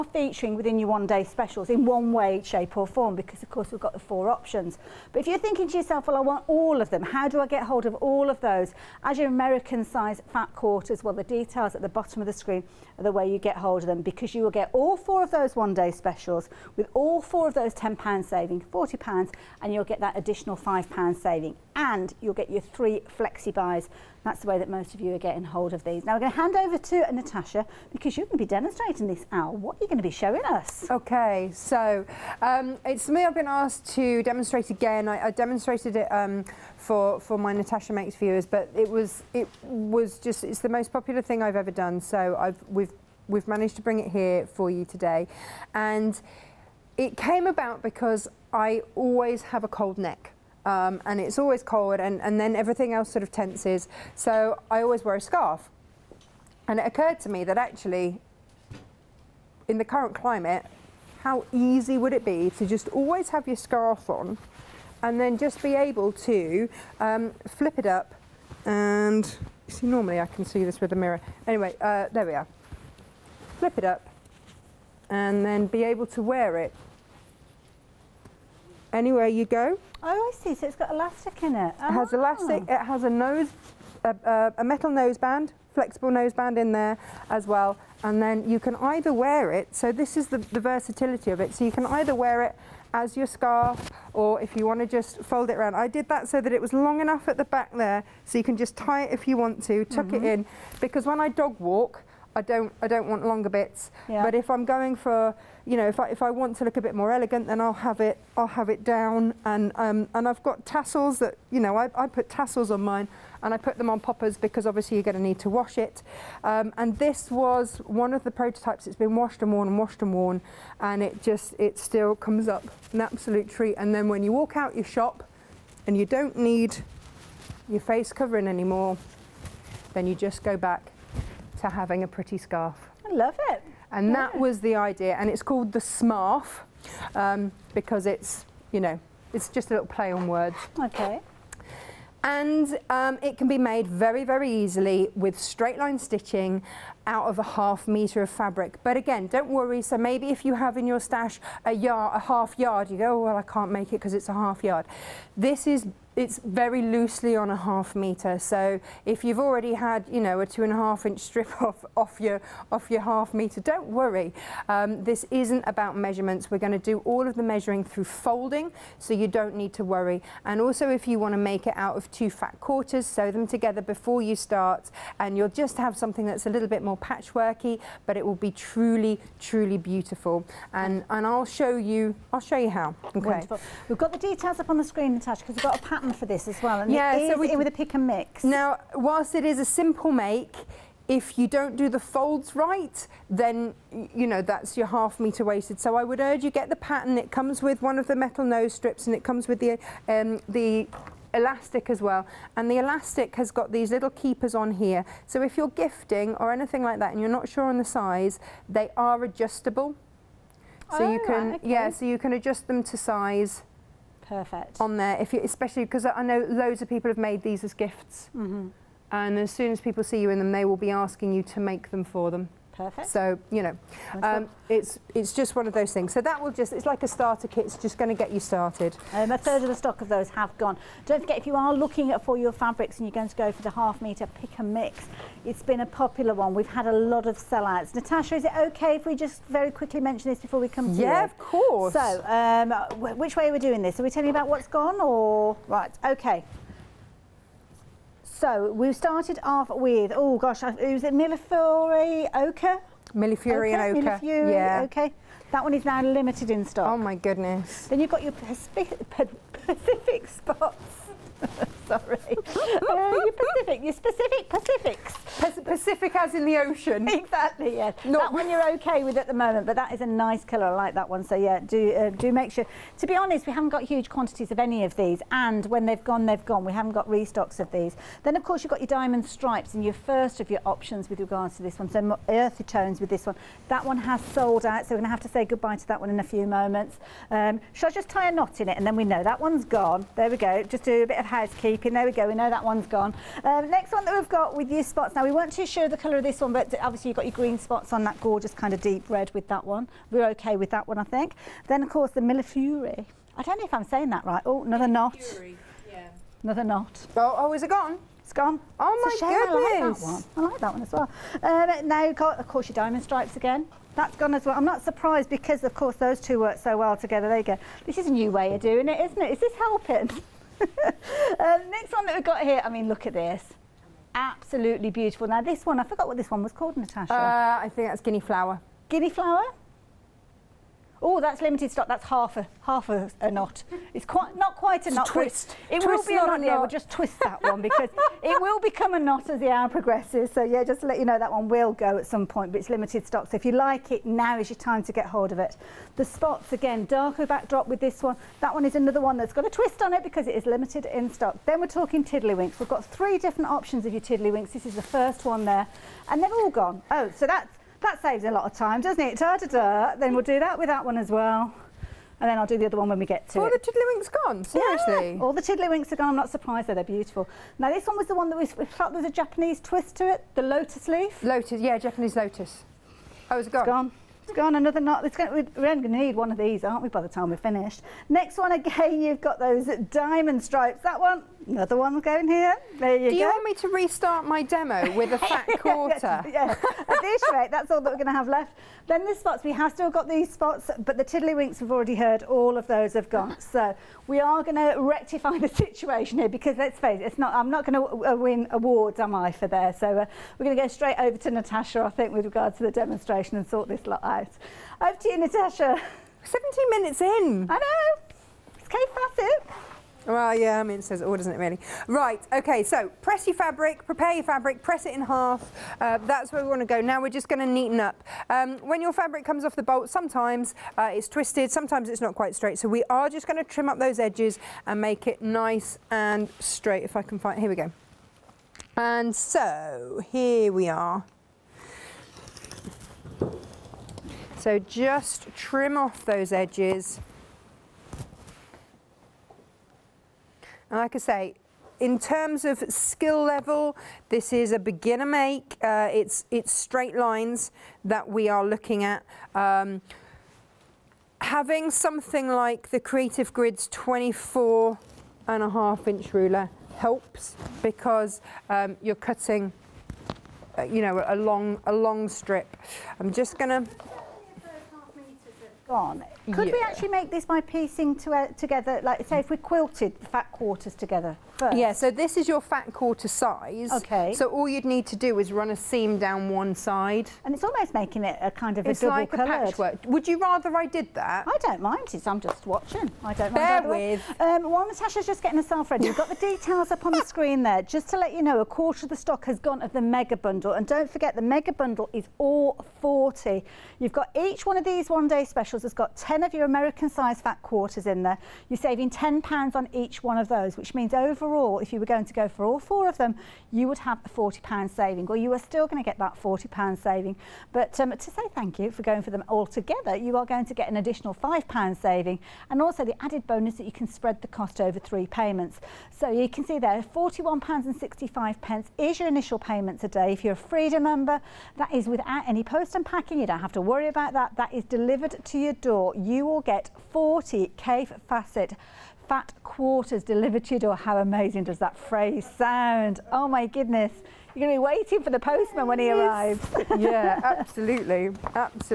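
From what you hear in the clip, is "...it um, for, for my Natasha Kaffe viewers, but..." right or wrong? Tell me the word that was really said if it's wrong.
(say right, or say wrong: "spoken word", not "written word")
wrong: "Makes", not "Kaffe".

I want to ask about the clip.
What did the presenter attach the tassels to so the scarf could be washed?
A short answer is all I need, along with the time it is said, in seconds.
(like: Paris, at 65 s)
poppers, at 114 s.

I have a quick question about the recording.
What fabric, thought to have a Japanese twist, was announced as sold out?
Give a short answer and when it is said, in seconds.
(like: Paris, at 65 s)
lotus leaf, at 370 s.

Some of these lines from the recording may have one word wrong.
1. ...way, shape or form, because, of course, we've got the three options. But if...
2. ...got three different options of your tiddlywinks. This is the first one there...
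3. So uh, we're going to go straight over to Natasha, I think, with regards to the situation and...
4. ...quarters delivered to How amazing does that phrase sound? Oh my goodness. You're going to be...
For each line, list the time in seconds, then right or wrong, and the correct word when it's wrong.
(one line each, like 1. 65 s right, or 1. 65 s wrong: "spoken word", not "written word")
1. 2 s wrong: "four", not "three"
2. 352 s right
3. 399 s wrong: "demonstration", not "situation"
4. 529 s right.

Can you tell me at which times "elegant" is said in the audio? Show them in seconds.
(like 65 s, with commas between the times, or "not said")
107 s.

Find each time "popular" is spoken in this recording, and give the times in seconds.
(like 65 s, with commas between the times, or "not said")
40 s, 235 s.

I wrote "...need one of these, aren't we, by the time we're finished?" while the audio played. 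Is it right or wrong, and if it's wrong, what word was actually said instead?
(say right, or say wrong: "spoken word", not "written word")
right.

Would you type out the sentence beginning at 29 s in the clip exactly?
What are you going to be showing us?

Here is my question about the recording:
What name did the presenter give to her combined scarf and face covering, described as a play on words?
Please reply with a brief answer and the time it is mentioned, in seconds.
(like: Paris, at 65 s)
smarf, at 135 s.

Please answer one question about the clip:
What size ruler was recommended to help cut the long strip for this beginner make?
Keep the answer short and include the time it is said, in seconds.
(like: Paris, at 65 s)
24 and a half inch, at 453 s.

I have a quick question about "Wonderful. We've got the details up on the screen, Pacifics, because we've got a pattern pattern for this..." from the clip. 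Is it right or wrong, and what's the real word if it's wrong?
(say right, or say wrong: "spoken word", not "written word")
wrong: "Natasha", not "Pacifics".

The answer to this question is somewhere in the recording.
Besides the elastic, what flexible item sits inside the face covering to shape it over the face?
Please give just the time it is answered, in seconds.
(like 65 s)
84 s.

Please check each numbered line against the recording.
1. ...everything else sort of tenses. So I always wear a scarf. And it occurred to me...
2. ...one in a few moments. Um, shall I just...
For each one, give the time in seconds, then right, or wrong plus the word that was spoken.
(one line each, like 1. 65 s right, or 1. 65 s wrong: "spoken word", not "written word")
1. 52 s right
2. 286 s right.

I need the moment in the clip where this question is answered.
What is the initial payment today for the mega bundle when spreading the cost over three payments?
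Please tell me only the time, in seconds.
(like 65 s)
516 s.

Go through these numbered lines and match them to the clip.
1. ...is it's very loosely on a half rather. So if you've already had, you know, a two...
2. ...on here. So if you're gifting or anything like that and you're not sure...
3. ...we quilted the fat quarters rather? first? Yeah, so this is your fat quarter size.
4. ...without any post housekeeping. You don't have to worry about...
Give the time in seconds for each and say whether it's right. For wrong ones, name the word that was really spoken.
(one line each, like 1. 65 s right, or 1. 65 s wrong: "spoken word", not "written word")
1. 155 s wrong: "meter", not "rather"
2. 204 s right
3. 469 s wrong: "together", not "rather"
4. 521 s wrong: "unpacking", not "housekeeping".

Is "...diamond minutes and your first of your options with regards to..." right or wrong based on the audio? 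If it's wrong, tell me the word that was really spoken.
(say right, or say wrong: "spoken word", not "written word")
wrong: "stripes", not "minutes".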